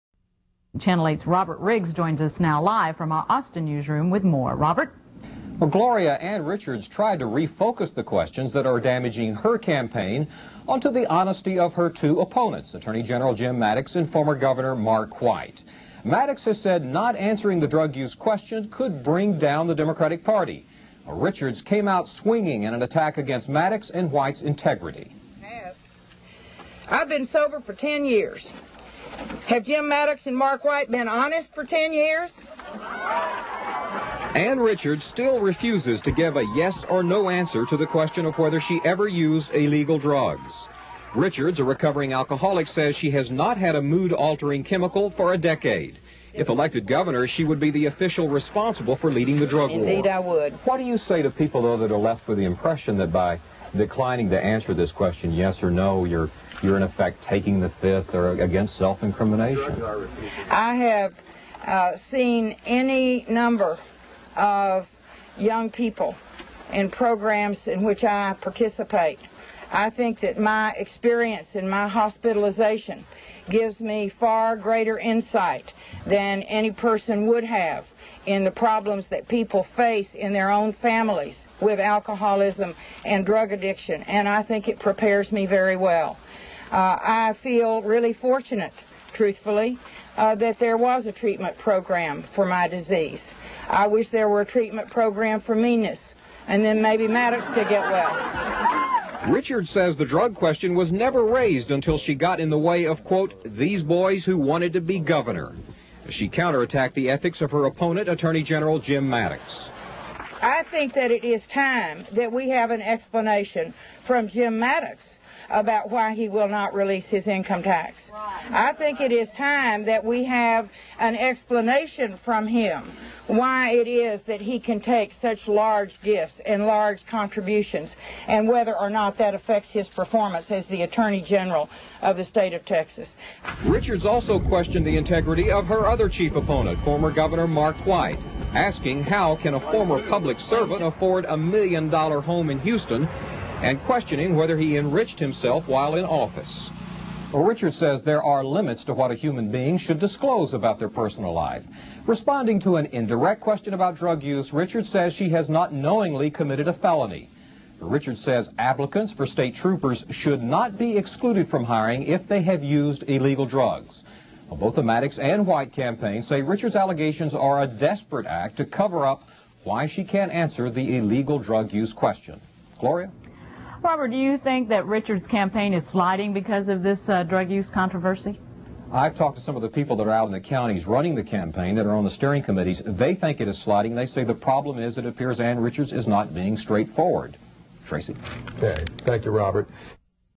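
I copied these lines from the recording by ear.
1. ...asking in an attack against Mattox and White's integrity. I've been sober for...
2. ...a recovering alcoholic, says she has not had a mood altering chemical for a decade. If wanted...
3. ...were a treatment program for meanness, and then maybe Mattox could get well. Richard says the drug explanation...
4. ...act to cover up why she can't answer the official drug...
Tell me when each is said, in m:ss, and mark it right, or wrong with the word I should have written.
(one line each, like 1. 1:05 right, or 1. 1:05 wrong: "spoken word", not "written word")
1. 0:22 wrong: "swinging", not "asking"
2. 0:41 wrong: "elected", not "wanted"
3. 1:34 wrong: "question", not "explanation"
4. 2:48 wrong: "illegal", not "official".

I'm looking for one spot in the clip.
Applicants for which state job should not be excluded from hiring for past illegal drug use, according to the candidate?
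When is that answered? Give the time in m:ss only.
2:39.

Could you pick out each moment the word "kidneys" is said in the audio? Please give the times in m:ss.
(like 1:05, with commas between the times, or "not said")
not said.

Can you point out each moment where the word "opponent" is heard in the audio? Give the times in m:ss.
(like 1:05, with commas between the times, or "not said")
0:12, 1:47, 2:16.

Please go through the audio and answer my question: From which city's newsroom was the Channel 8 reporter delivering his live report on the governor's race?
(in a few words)
Austin.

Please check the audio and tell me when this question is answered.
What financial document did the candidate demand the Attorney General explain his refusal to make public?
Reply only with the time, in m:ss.
1:57.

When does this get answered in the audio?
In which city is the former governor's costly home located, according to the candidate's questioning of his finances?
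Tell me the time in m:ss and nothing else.
2:22.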